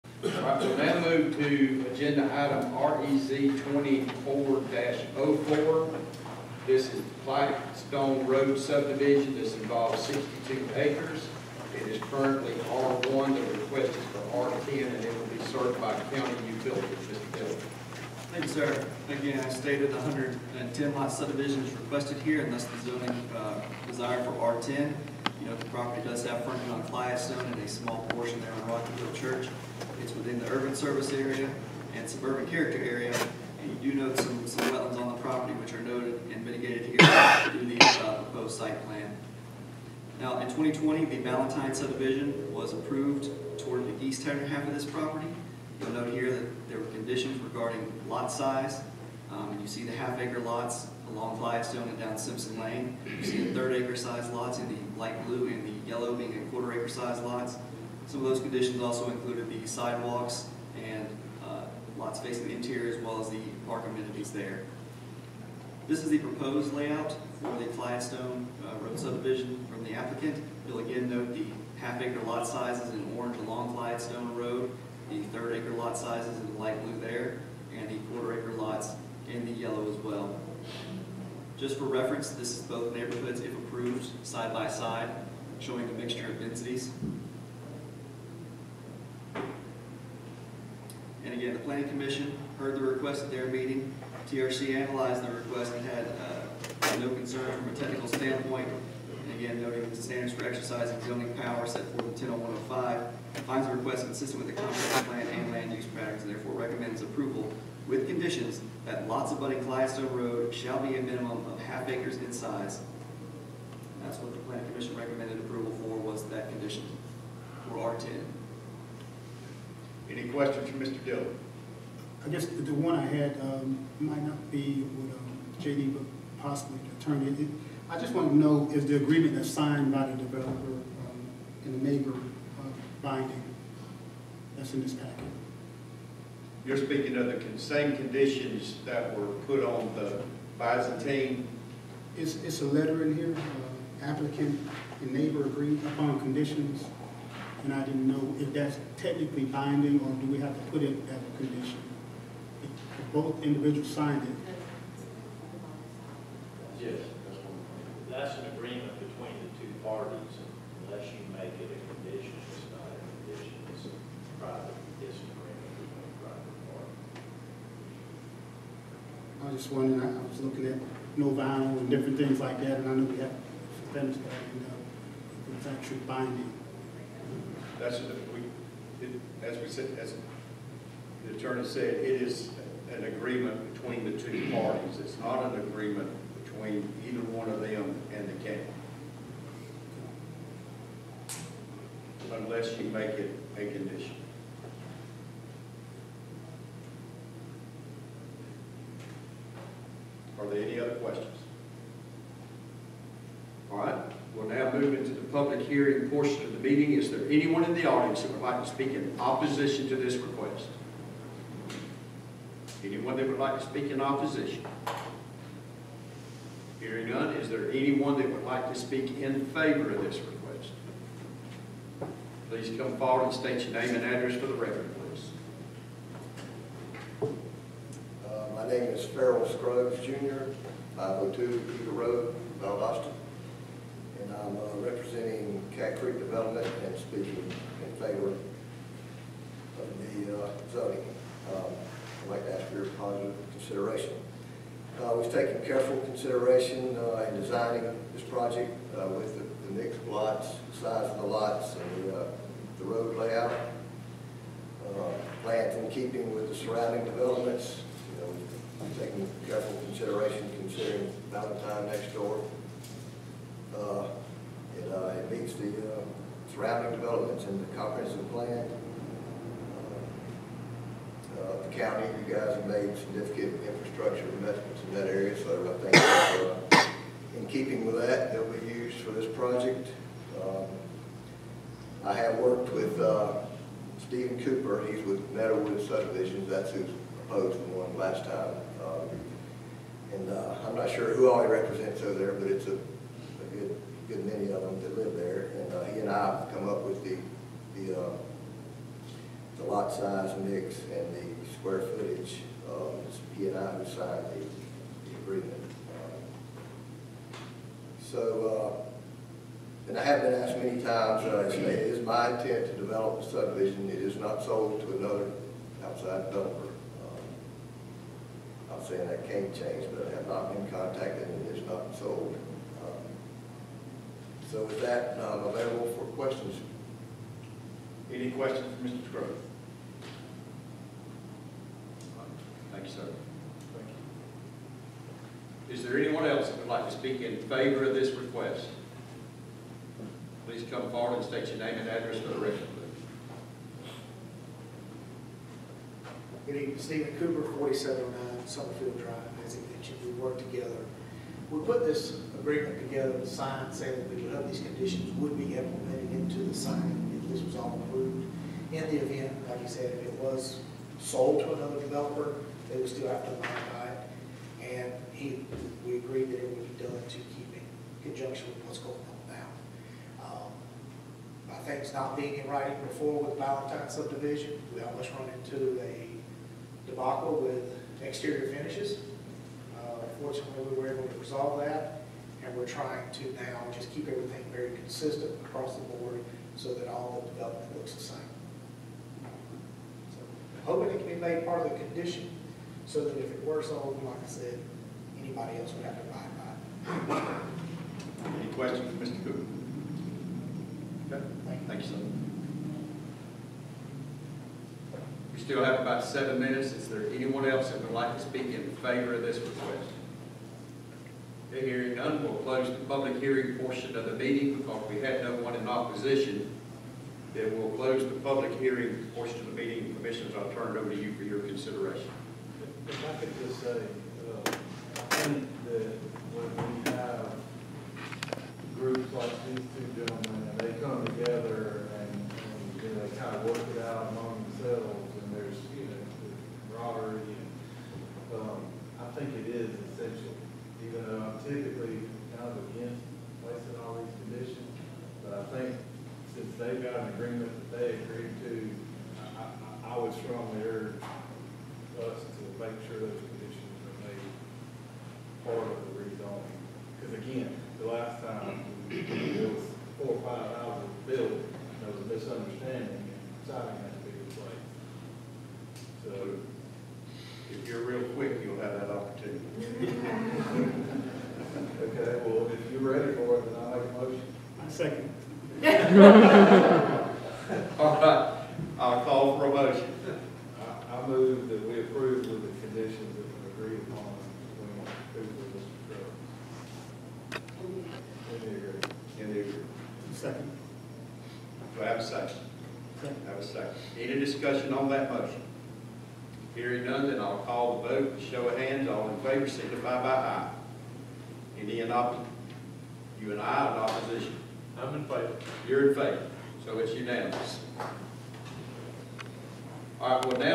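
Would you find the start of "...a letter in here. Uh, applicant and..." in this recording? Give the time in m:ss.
2:22.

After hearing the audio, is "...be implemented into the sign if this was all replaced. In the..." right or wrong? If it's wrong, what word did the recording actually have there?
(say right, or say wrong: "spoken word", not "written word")
wrong: "approved", not "replaced".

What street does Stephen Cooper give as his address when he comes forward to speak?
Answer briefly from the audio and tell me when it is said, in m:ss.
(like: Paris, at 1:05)
Summerfield Drive, at 5:48.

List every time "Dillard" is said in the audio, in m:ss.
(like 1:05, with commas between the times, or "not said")
0:17, 2:01.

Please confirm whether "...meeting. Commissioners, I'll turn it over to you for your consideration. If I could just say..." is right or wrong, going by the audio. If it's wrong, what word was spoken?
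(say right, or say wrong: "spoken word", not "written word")
right.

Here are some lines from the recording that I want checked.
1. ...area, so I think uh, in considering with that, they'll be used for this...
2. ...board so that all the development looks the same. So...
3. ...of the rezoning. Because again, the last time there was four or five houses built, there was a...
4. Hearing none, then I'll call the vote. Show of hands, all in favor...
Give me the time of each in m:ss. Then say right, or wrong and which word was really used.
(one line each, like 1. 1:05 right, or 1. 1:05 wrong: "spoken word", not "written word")
1. 4:35 wrong: "keeping", not "considering"
2. 6:25 right
3. 7:35 right
4. 8:16 right.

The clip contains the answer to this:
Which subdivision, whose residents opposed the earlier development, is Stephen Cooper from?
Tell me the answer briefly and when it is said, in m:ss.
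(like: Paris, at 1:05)
Meadowwood, at 4:45.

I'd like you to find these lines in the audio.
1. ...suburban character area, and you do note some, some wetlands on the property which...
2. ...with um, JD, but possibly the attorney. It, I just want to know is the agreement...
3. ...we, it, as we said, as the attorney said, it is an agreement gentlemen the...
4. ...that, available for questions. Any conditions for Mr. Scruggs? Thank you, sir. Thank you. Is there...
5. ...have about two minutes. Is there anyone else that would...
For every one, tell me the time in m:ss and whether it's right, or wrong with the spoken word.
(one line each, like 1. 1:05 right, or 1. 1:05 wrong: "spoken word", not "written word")
1. 0:32 right
2. 2:04 right
3. 2:58 wrong: "between", not "gentlemen"
4. 5:24 wrong: "questions", not "conditions"
5. 6:45 wrong: "seven", not "two".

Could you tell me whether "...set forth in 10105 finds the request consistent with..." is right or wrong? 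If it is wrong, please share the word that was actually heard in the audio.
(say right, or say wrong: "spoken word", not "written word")
right.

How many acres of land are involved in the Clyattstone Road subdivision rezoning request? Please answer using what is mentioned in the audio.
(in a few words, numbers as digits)
62.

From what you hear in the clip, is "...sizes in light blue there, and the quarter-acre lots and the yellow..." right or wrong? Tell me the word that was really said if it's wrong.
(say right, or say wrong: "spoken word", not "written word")
right.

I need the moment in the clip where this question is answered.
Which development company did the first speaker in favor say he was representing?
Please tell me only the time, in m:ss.
3:55.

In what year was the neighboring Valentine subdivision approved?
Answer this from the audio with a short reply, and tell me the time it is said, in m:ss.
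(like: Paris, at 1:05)
2020, at 0:40.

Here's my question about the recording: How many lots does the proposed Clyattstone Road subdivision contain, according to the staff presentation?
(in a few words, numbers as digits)
110.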